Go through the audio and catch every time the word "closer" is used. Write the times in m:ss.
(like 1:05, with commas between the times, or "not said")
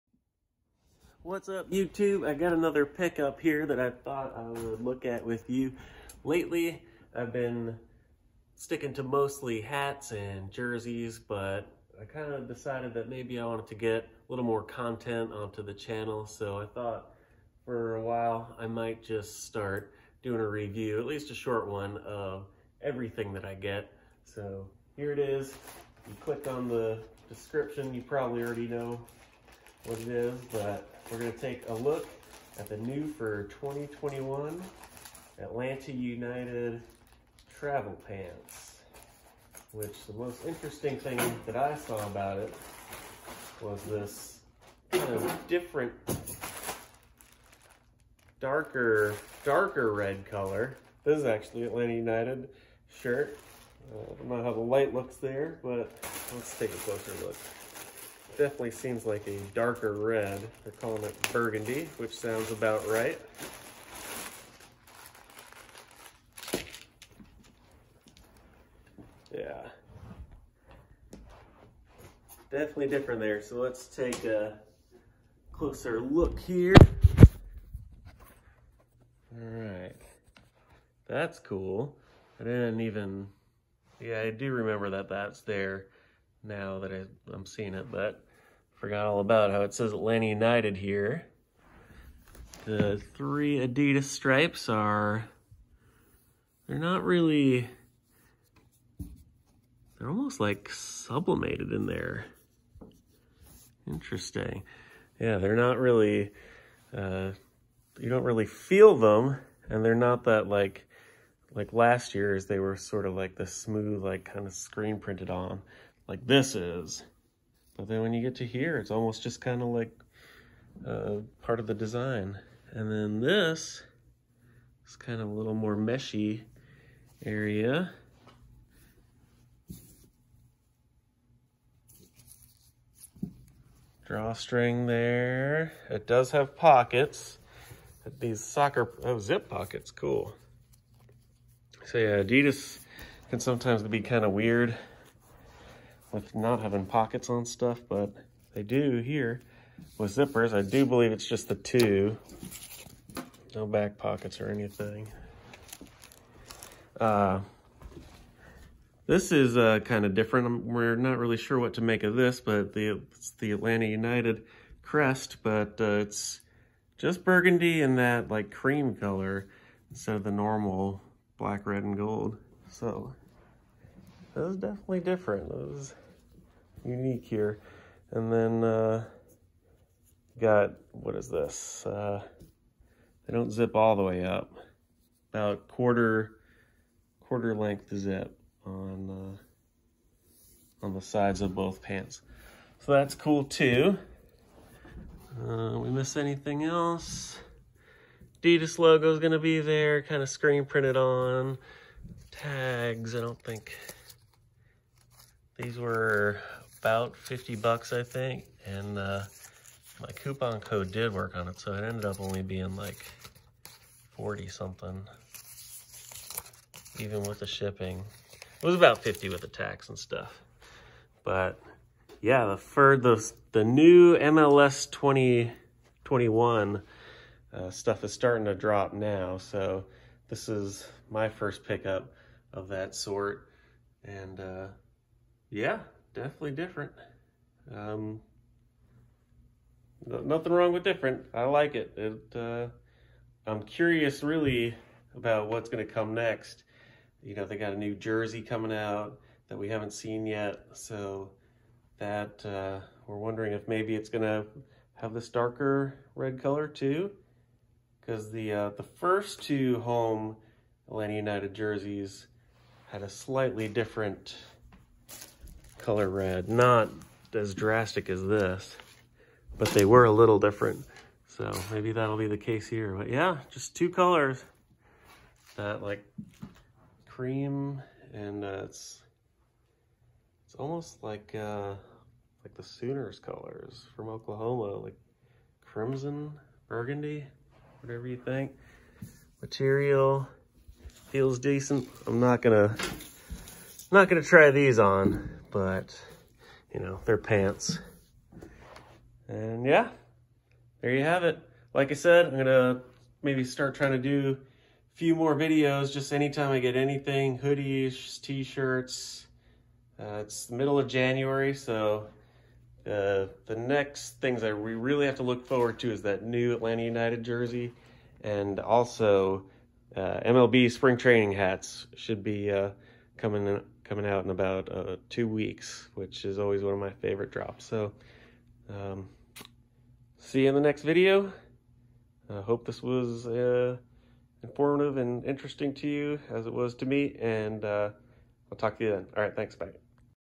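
0:56, 1:15.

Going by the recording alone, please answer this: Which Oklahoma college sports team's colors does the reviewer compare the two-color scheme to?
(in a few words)
Sooners.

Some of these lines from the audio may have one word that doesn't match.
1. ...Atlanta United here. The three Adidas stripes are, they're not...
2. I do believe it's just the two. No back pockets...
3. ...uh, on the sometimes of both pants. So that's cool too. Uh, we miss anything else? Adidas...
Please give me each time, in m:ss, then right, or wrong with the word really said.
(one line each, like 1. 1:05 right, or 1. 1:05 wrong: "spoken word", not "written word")
1. 1:29 right
2. 2:30 right
3. 3:10 wrong: "sides", not "sometimes".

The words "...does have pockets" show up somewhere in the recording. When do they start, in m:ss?
2:16.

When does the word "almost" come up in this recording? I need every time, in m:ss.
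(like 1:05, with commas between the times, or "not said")
1:40, 1:58, 4:40.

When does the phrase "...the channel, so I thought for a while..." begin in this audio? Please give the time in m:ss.
0:15.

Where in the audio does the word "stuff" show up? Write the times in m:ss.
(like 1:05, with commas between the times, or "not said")
2:27, 3:39, 3:47.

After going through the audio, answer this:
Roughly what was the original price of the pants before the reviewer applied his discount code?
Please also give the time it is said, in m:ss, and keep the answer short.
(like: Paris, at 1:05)
$50, at 3:27.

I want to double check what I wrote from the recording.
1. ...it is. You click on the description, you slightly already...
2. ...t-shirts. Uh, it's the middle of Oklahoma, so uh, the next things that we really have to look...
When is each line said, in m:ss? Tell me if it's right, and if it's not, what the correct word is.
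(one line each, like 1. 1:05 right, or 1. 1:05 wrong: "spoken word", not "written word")
1. 0:25 wrong: "probably", not "slightly"
2. 5:08 wrong: "January", not "Oklahoma".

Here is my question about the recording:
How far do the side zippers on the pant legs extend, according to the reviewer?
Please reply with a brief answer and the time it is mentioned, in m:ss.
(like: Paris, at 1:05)
Quarter length, at 3:07.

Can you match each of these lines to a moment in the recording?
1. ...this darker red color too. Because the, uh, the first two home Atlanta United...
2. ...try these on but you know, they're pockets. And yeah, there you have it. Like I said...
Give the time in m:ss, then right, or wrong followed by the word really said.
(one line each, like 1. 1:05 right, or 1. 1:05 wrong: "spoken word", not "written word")
1. 4:15 right
2. 4:54 wrong: "pants", not "pockets".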